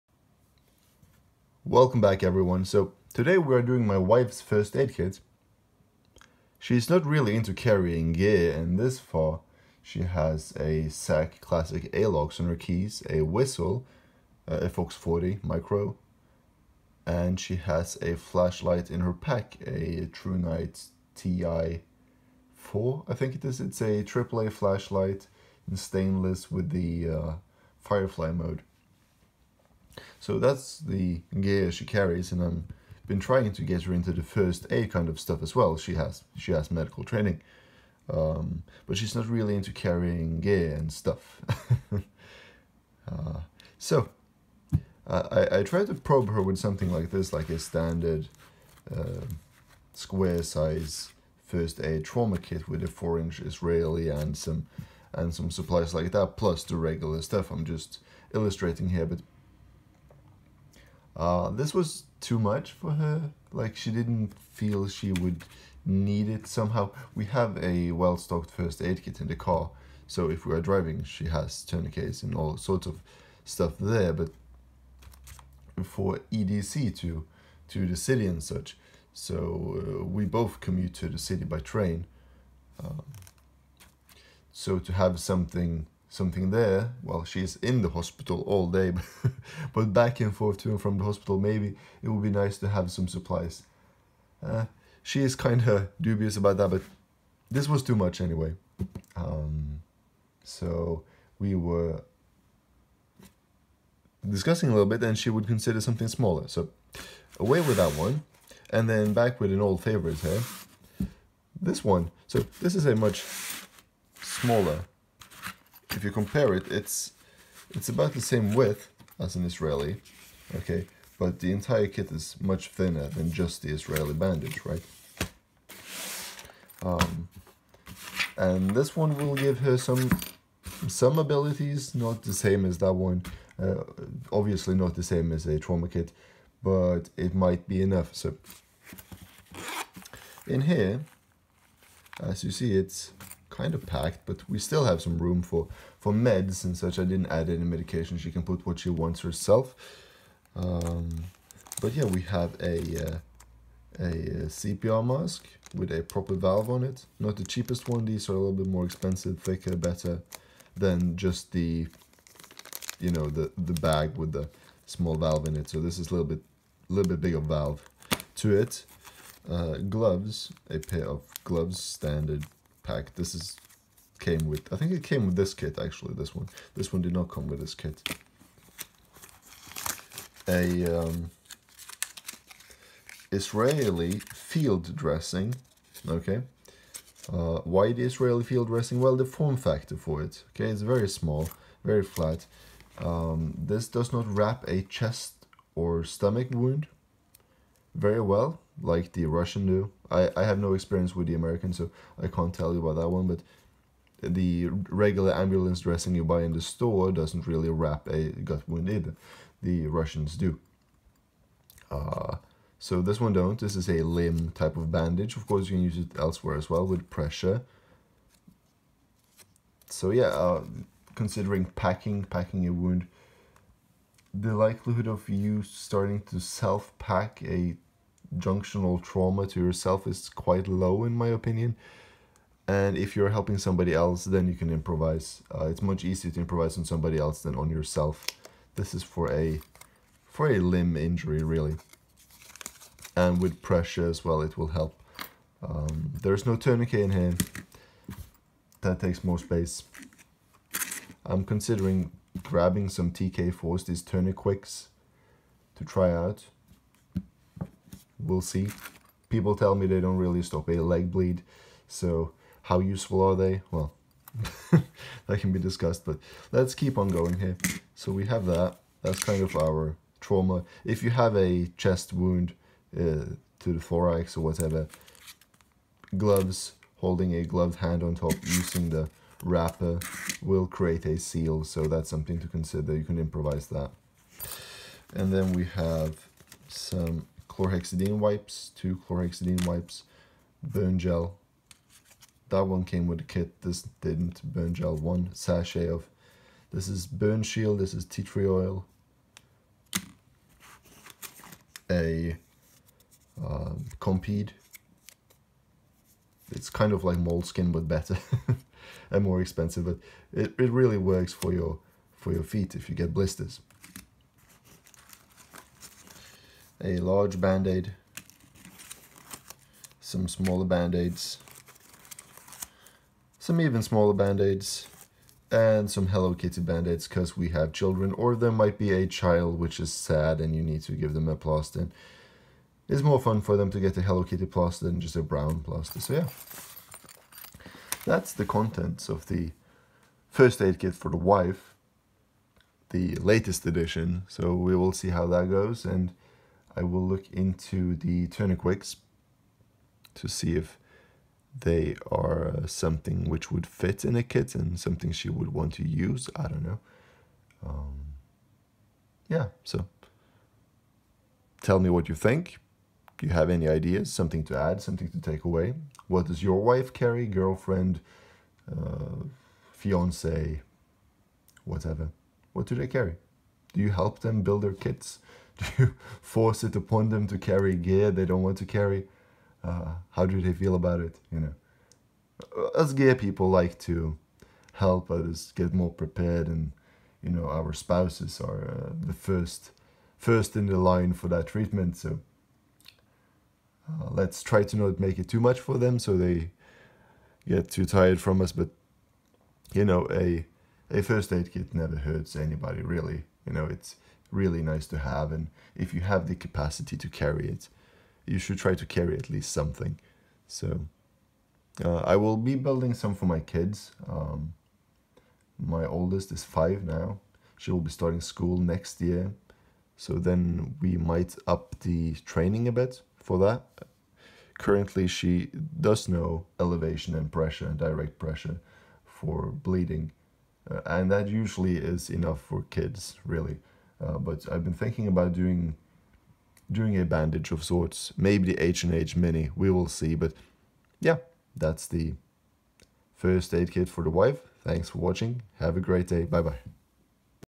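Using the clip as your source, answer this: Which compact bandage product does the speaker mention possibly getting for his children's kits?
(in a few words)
H&H Mini.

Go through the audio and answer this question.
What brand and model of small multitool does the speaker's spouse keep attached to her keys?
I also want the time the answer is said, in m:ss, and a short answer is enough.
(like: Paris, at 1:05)
SAK Classic Alox, at 0:10.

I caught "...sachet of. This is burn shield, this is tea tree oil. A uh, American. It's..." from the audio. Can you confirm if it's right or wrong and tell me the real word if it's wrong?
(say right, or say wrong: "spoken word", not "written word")
wrong: "Compeed", not "American".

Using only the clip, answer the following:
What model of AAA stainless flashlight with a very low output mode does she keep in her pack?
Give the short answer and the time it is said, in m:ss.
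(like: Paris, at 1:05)
ThruNite TI-4, at 0:20.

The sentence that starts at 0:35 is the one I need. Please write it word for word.
She has she has medical training, um, but she's not really into carrying gear and stuff.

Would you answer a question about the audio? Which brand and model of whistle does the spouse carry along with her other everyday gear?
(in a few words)
Fox 40 micro.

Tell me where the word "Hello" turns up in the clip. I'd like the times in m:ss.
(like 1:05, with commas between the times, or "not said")
5:26, 5:34.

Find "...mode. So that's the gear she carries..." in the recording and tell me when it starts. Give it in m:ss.
0:28.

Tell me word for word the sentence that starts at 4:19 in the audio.
People tell me they don't really stop a leg bleed, so how useful are they?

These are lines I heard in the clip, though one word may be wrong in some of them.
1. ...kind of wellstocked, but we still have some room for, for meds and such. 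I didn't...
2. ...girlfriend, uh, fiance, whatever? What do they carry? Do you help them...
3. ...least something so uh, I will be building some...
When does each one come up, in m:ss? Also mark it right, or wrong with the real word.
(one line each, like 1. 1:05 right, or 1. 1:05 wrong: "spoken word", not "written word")
1. 2:23 wrong: "packed", not "wellstocked"
2. 6:07 right
3. 6:49 right.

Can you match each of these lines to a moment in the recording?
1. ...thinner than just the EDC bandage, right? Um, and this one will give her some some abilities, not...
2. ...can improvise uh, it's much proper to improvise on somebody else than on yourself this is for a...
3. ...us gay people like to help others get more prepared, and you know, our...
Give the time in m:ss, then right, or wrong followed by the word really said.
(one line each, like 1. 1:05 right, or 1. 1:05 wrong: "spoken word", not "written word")
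1. 2:02 wrong: "Israeli", not "EDC"
2. 3:54 wrong: "easier", not "proper"
3. 6:22 right.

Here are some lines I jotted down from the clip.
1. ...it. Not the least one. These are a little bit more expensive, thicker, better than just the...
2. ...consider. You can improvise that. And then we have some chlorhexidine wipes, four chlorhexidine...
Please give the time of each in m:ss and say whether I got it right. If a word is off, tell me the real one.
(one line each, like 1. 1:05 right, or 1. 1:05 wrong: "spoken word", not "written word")
1. 2:36 wrong: "cheapest", not "least"
2. 4:42 wrong: "two", not "four".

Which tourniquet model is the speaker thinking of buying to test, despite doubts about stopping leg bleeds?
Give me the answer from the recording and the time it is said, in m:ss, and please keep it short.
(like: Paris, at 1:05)
TK4, at 4:13.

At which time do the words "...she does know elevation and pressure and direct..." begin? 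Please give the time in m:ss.
7:05.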